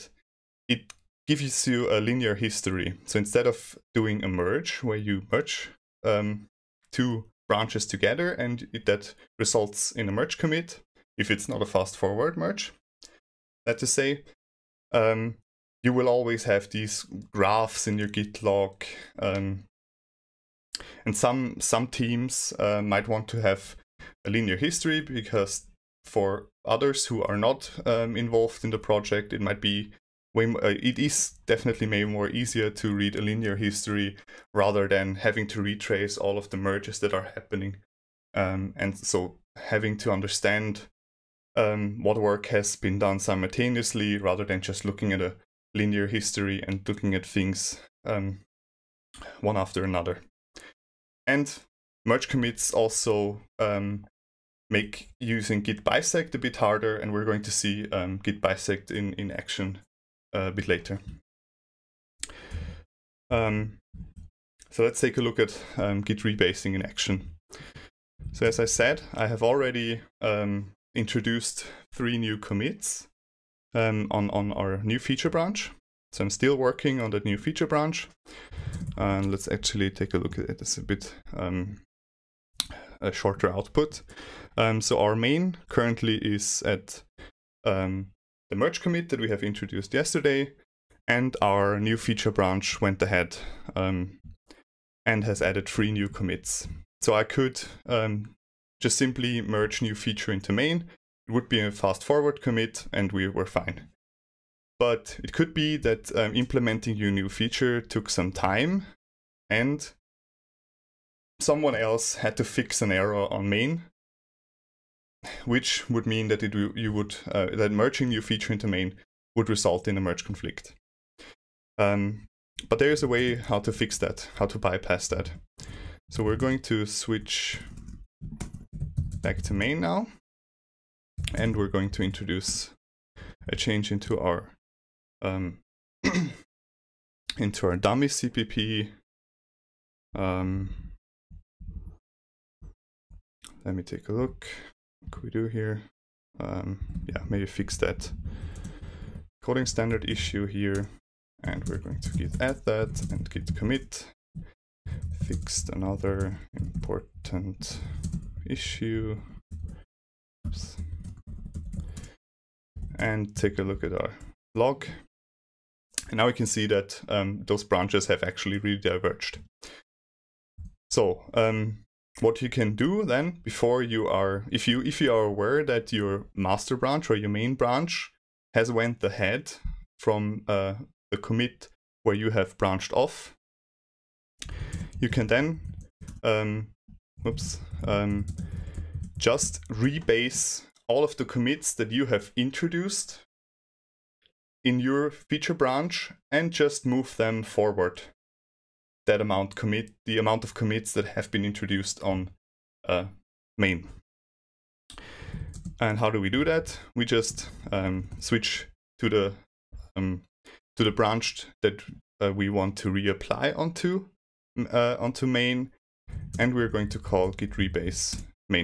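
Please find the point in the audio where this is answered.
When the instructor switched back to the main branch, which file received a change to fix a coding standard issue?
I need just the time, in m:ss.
2:17.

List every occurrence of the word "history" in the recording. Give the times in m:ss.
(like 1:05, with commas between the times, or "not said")
0:02, 0:24, 0:33, 0:46.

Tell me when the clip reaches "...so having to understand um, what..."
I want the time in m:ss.
0:38.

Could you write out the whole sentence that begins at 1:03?
Um, so let's take a look at um, Git rebasing in action.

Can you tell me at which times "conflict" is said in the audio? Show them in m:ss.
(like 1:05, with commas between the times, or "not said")
2:00.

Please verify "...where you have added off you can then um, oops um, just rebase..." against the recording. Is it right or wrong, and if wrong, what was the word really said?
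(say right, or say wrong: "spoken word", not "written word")
wrong: "branched", not "added".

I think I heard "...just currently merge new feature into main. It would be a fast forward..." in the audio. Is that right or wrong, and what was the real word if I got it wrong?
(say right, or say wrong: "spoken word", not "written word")
wrong: "simply", not "currently".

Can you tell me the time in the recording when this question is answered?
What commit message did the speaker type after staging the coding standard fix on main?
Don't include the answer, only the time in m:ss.
2:35.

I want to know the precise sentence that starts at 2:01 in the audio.
Um, but there is a way how to fix that, how to bypass that.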